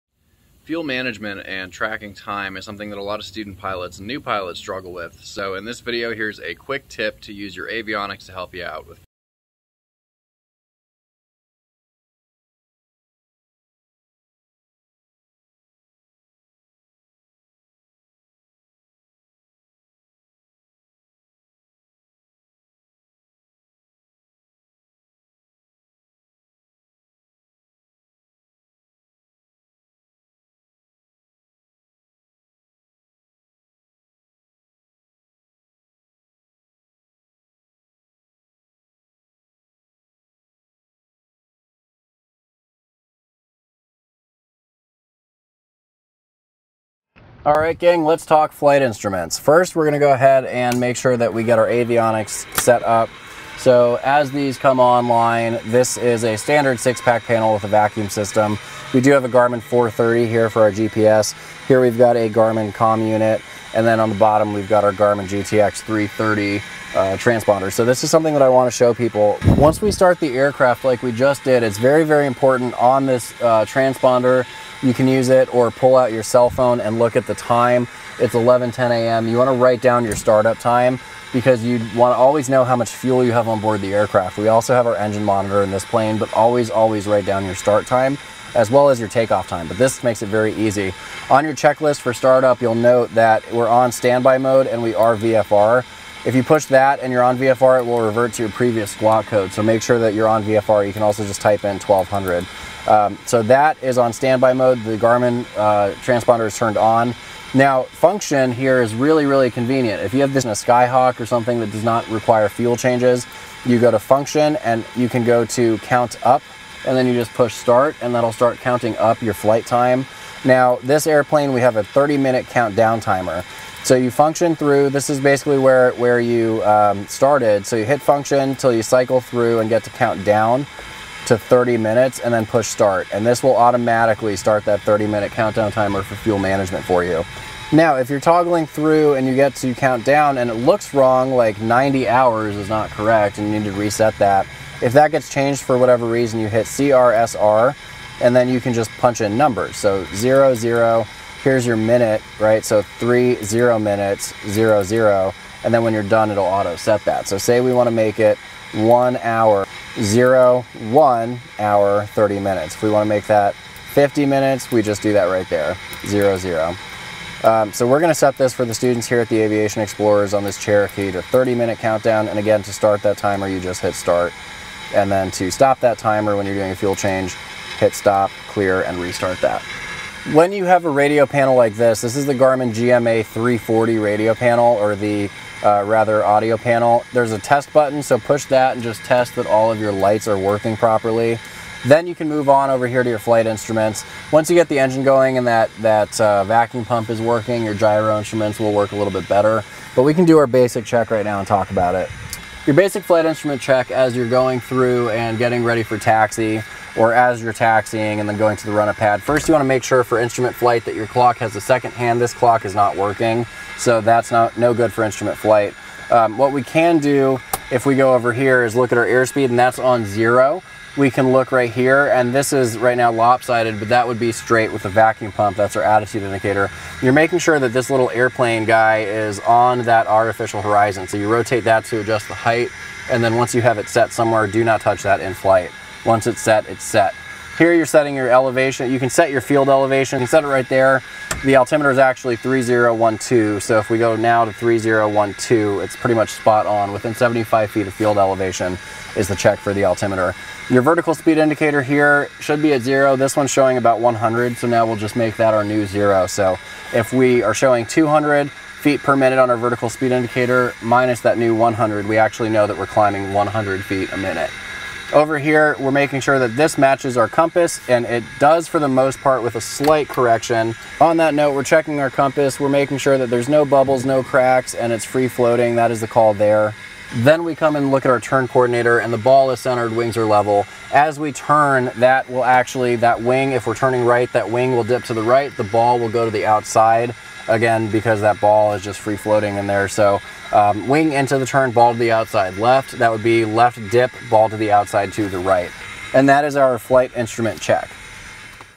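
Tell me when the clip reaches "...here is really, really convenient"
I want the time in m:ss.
1:48.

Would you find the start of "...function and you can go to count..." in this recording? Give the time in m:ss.
1:53.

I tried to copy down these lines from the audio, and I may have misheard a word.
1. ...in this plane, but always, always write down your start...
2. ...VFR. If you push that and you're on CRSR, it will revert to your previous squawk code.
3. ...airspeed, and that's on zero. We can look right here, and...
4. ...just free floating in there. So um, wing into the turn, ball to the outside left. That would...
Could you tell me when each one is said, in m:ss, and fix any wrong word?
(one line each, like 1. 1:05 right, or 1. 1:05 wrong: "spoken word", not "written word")
1. 1:25 right
2. 1:35 wrong: "VFR", not "CRSR"
3. 3:39 right
4. 4:48 right.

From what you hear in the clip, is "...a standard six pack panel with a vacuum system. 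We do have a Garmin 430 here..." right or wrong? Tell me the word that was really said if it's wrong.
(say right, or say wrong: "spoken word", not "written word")
right.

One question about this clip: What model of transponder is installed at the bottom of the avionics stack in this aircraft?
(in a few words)
Garmin GTX 330.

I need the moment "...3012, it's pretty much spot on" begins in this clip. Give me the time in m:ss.
4:04.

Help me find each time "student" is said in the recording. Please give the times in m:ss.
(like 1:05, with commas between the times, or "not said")
0:03, 2:48.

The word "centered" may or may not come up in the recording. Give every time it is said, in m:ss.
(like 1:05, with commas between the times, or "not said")
4:39.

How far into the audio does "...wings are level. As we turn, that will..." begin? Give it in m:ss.
4:39.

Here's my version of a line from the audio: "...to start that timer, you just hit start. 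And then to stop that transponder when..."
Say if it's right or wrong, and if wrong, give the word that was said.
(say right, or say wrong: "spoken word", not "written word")
wrong: "timer", not "transponder".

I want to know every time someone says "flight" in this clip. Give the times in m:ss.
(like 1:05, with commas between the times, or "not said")
0:48, 1:59, 3:13, 3:23, 3:30, 3:35, 3:55, 4:56.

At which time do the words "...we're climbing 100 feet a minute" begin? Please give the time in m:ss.
4:22.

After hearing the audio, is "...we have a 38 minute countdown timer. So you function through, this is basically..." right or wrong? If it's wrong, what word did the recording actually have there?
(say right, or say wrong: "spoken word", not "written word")
wrong: "30", not "38".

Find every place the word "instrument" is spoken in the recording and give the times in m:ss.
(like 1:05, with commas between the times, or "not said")
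0:48, 3:13, 3:18, 3:23, 3:30, 3:35, 4:57.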